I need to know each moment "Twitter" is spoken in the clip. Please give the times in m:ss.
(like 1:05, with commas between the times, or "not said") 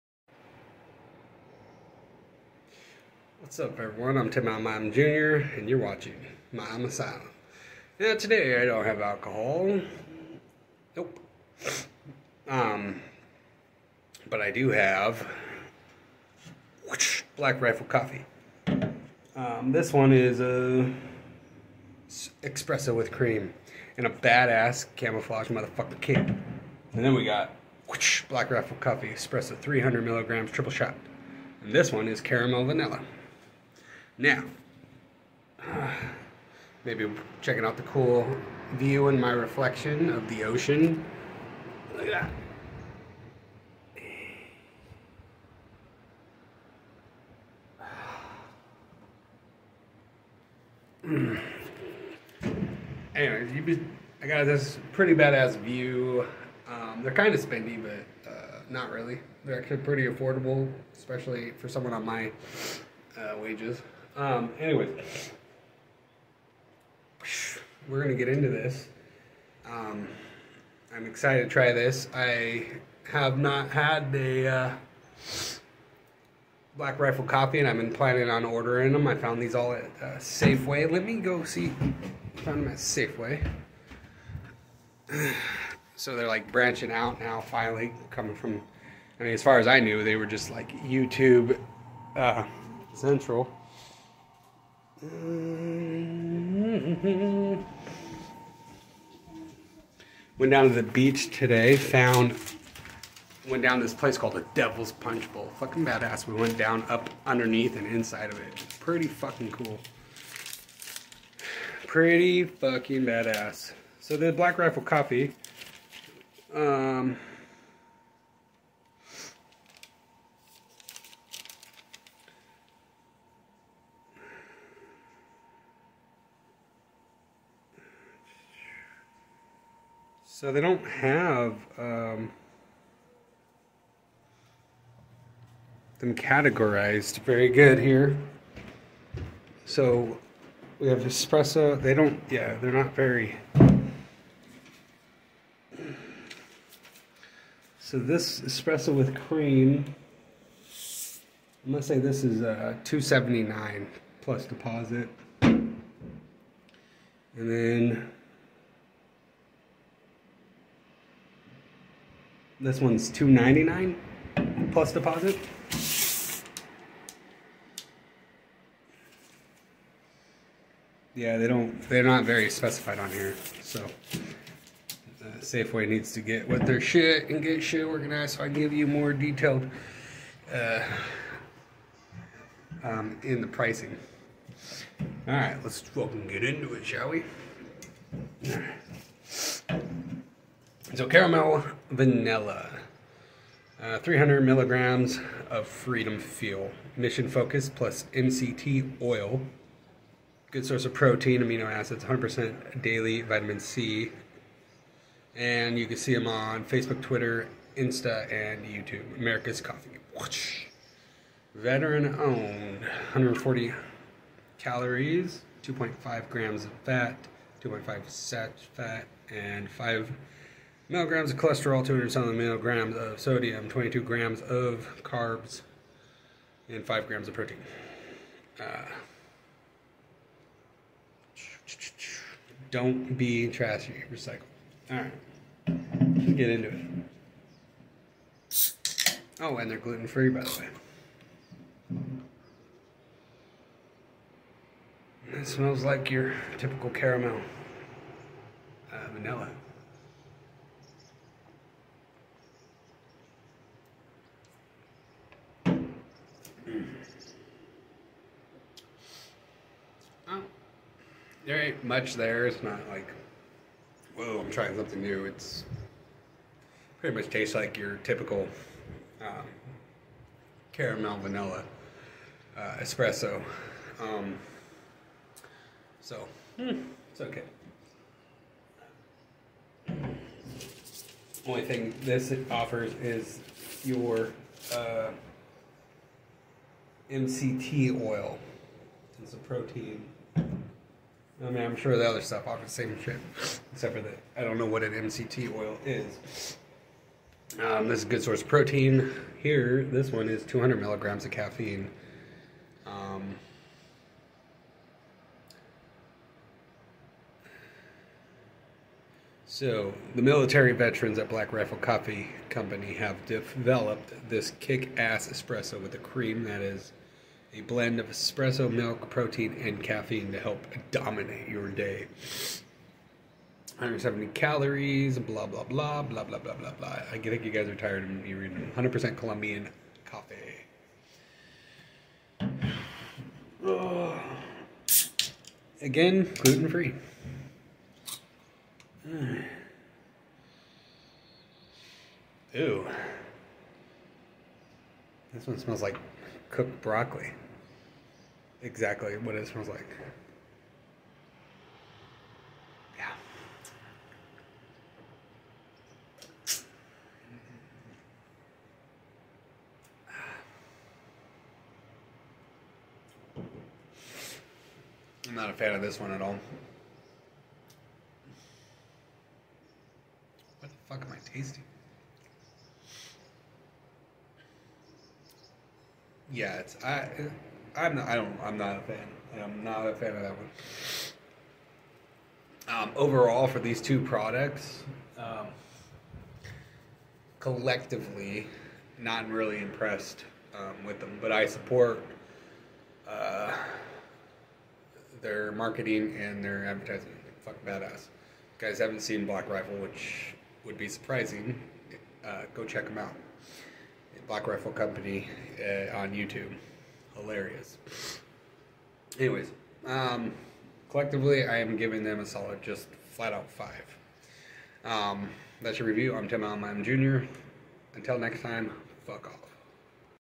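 3:27.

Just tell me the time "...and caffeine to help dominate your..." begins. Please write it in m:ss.
5:19.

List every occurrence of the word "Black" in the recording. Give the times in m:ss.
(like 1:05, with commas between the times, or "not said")
0:17, 0:28, 1:16, 1:54, 5:11, 6:39, 6:44.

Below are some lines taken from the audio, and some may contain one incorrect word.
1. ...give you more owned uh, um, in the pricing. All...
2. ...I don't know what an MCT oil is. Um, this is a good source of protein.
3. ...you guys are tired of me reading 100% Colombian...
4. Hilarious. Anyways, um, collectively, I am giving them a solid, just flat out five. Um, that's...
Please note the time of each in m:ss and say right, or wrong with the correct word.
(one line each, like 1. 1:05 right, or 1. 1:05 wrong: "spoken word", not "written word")
1. 2:58 wrong: "detailed", not "owned"
2. 4:54 right
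3. 5:27 right
4. 6:47 right.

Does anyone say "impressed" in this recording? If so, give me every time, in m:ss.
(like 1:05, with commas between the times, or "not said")
6:29.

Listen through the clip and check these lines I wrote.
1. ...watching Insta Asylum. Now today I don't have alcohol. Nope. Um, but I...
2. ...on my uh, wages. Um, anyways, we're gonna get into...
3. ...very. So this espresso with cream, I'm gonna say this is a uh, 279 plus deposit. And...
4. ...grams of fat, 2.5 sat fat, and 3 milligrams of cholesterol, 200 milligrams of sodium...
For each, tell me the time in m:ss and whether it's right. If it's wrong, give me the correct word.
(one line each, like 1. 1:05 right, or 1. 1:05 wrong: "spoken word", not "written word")
1. 0:05 wrong: "Milam", not "Insta"
2. 1:01 right
3. 2:22 right
4. 3:36 wrong: "5", not "3".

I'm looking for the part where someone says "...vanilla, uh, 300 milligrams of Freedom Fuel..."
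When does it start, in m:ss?
3:11.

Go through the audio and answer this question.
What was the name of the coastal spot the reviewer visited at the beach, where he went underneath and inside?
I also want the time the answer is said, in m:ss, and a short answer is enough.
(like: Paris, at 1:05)
Devil's Punch Bowl, at 1:44.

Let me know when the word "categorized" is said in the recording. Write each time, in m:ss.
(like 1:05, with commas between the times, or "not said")
2:16.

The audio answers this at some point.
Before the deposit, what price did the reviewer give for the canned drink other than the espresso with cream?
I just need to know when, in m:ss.
2:43.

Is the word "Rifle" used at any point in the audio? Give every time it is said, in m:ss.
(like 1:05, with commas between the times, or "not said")
0:17, 0:28, 1:16, 1:54, 5:11, 6:39, 6:44.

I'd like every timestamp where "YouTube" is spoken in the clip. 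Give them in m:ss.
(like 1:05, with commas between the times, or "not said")
1:30, 3:28, 6:46.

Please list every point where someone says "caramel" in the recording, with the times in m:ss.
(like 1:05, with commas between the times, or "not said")
0:32, 3:11, 4:06, 4:30.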